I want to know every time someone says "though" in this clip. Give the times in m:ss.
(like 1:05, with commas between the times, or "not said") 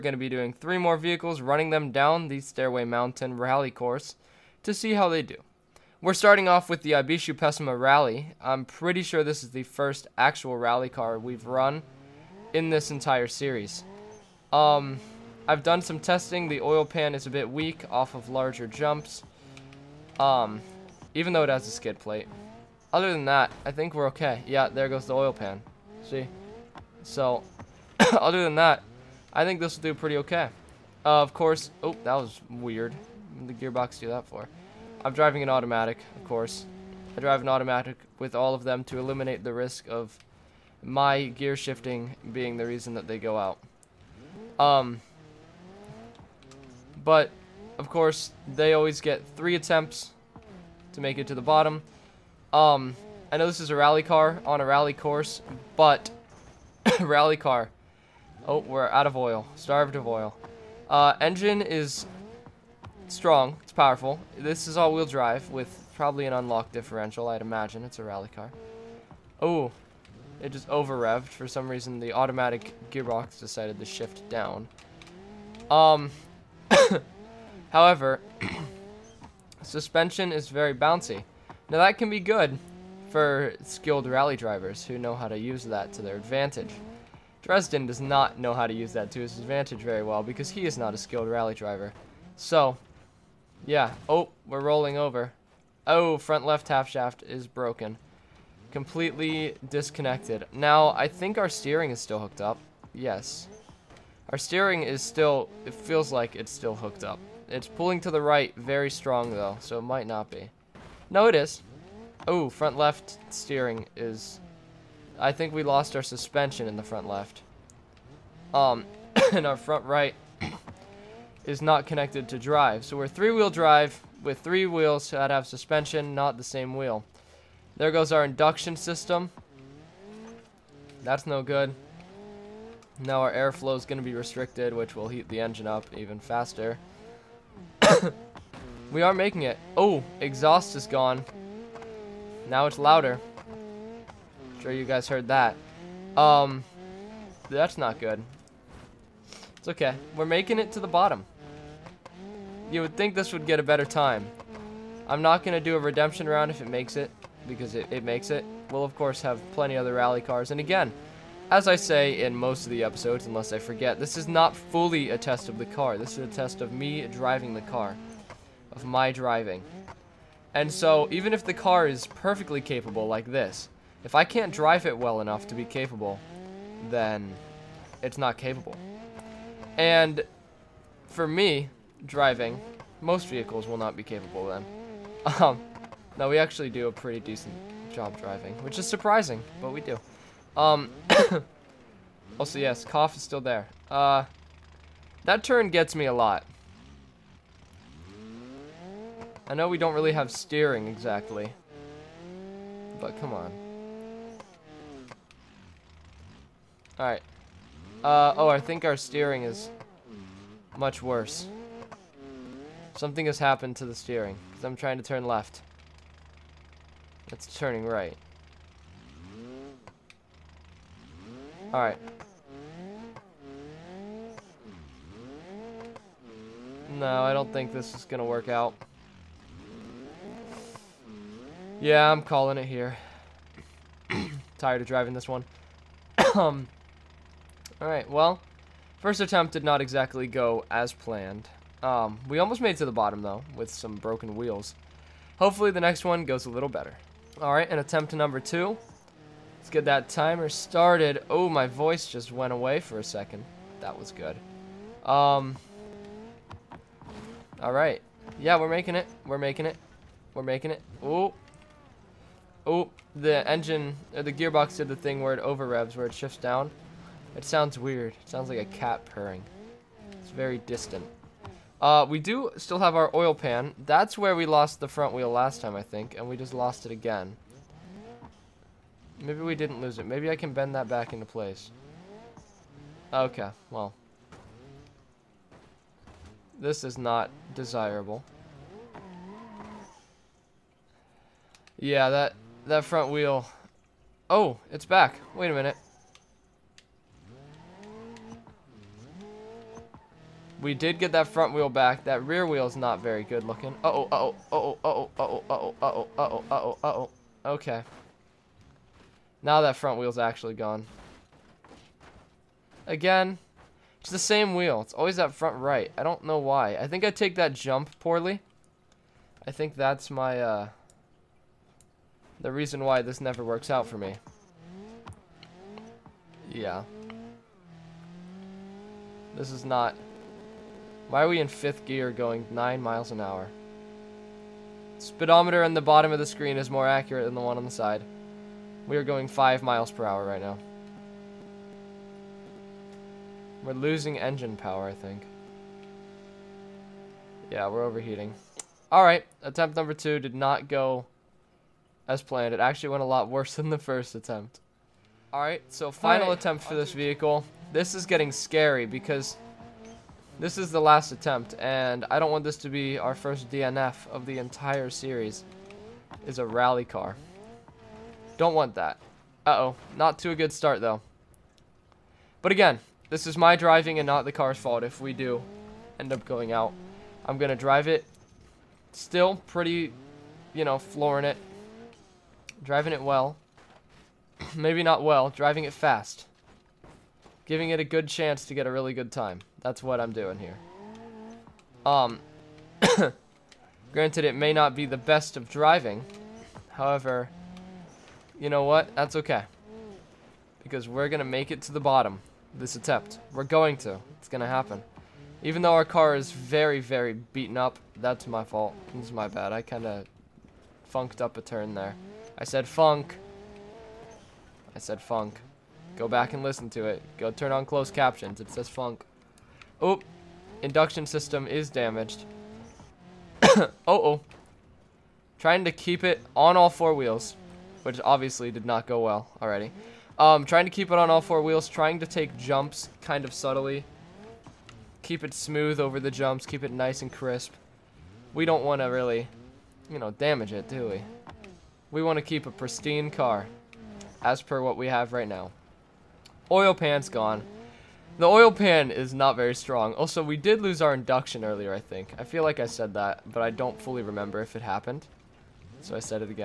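0:21, 1:49, 4:03, 6:10, 6:45.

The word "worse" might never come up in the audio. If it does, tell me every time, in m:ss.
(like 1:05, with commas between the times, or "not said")
3:31, 5:53.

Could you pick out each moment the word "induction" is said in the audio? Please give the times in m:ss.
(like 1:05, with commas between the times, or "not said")
2:08, 7:00, 7:30.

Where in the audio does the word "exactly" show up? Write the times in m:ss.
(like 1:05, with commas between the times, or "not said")
3:20, 3:59.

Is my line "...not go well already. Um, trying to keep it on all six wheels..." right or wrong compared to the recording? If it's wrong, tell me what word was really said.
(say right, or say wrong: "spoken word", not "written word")
wrong: "four", not "six".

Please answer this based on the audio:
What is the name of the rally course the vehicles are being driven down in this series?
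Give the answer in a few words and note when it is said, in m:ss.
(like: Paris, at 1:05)
Stairway Mountain Rally, at 0:02.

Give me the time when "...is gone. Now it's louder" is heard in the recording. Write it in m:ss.
2:20.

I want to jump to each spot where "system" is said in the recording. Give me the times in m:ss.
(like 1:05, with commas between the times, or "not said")
2:08, 7:01.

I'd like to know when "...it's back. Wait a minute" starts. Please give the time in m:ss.
4:54.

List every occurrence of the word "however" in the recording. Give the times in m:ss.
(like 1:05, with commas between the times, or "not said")
1:17, 6:36.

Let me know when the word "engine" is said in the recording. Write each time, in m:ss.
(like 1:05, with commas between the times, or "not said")
1:01, 2:15, 4:23, 5:44.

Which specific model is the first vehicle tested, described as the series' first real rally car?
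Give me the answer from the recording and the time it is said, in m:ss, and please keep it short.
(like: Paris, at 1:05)
Ibishu Pessima Rally, at 0:06.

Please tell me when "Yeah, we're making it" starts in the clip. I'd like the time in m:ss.
4:18.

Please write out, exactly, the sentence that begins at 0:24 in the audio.
Yeah, there goes the oil pan.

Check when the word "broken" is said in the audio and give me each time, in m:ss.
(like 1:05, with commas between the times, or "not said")
1:37, 4:03.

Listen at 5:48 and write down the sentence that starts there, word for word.
Alright, attempt number two did not go as planned.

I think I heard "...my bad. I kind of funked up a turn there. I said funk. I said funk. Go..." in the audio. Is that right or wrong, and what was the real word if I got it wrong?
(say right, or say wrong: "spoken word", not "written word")
right.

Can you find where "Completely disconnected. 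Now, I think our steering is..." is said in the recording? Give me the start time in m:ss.
1:38.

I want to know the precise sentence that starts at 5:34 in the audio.
Speedometer on the bottom of the screen is more accurate than the one on the side.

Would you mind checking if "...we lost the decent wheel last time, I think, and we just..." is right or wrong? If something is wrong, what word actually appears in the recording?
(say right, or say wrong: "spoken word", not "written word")
wrong: "front", not "decent".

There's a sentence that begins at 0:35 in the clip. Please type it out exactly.
I'm driving an automatic, of course.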